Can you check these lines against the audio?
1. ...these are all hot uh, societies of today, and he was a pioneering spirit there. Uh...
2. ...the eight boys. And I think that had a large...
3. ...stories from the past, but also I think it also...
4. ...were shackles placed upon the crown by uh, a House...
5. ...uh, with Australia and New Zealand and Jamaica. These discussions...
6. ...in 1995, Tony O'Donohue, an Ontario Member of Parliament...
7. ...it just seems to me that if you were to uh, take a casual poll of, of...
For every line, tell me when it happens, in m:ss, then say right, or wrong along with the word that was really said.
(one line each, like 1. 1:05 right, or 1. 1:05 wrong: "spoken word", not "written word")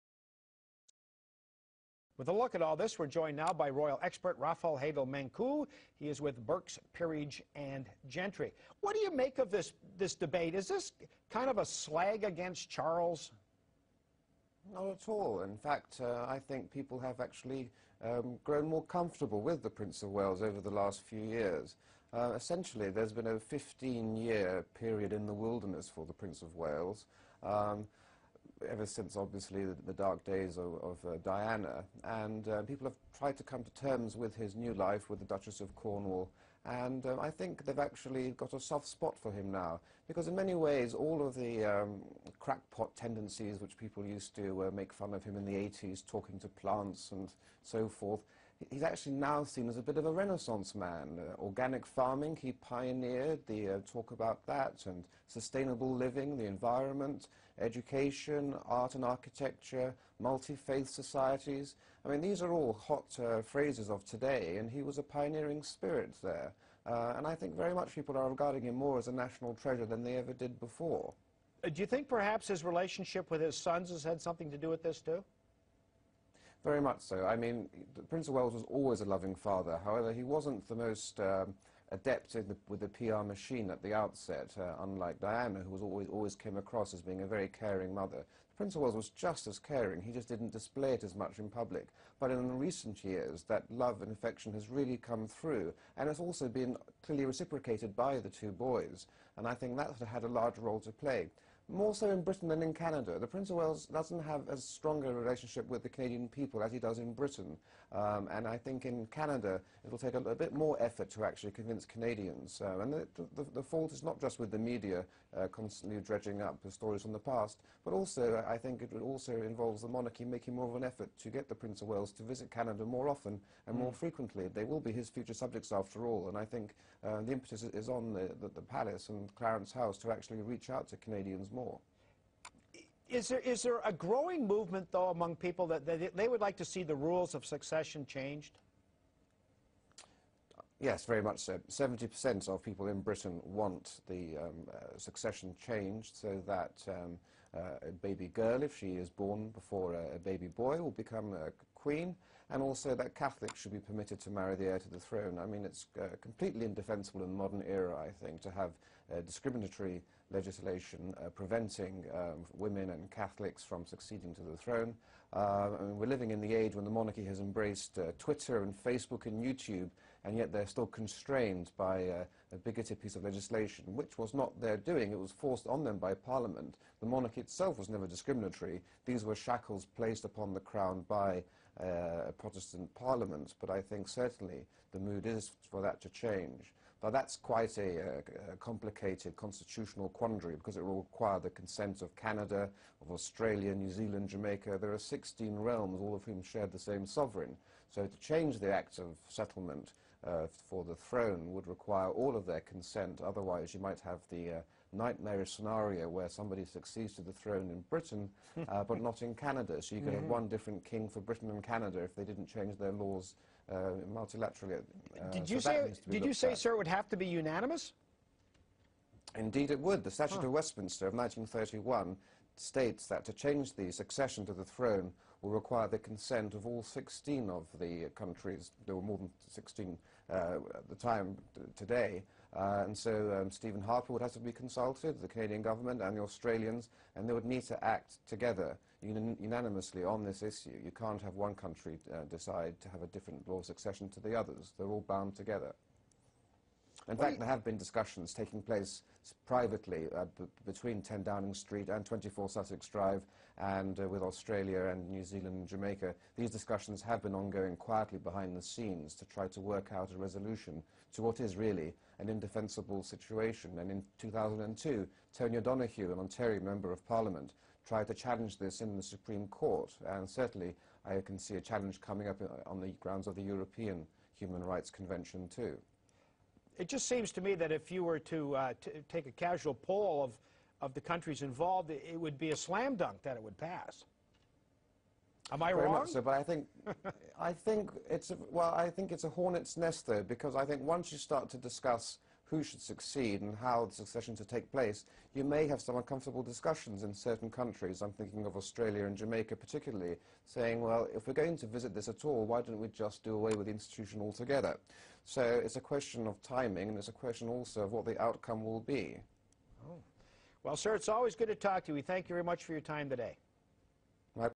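1. 1:02 wrong: "phrases", not "societies"
2. 1:38 wrong: "two", not "eight"
3. 1:56 right
4. 2:59 wrong: "Protestant", not "House"
5. 4:13 right
6. 4:23 wrong: "2002", not "1995"
7. 4:36 right.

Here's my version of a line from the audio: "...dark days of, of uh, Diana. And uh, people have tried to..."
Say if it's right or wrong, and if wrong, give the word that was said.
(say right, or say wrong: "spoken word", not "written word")
right.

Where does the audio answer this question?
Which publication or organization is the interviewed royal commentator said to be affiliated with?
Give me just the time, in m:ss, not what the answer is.
0:06.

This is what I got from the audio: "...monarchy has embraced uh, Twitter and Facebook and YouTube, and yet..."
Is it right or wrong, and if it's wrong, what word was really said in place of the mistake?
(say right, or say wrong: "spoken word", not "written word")
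right.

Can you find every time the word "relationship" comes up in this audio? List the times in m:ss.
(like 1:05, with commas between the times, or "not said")
1:12, 1:45.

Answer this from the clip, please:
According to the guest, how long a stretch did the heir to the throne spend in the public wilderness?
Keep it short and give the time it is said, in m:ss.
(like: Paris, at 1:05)
15-year period, at 0:23.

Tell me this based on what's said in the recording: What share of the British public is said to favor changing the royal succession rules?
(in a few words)
70%.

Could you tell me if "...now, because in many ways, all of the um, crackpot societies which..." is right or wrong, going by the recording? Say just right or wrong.
wrong.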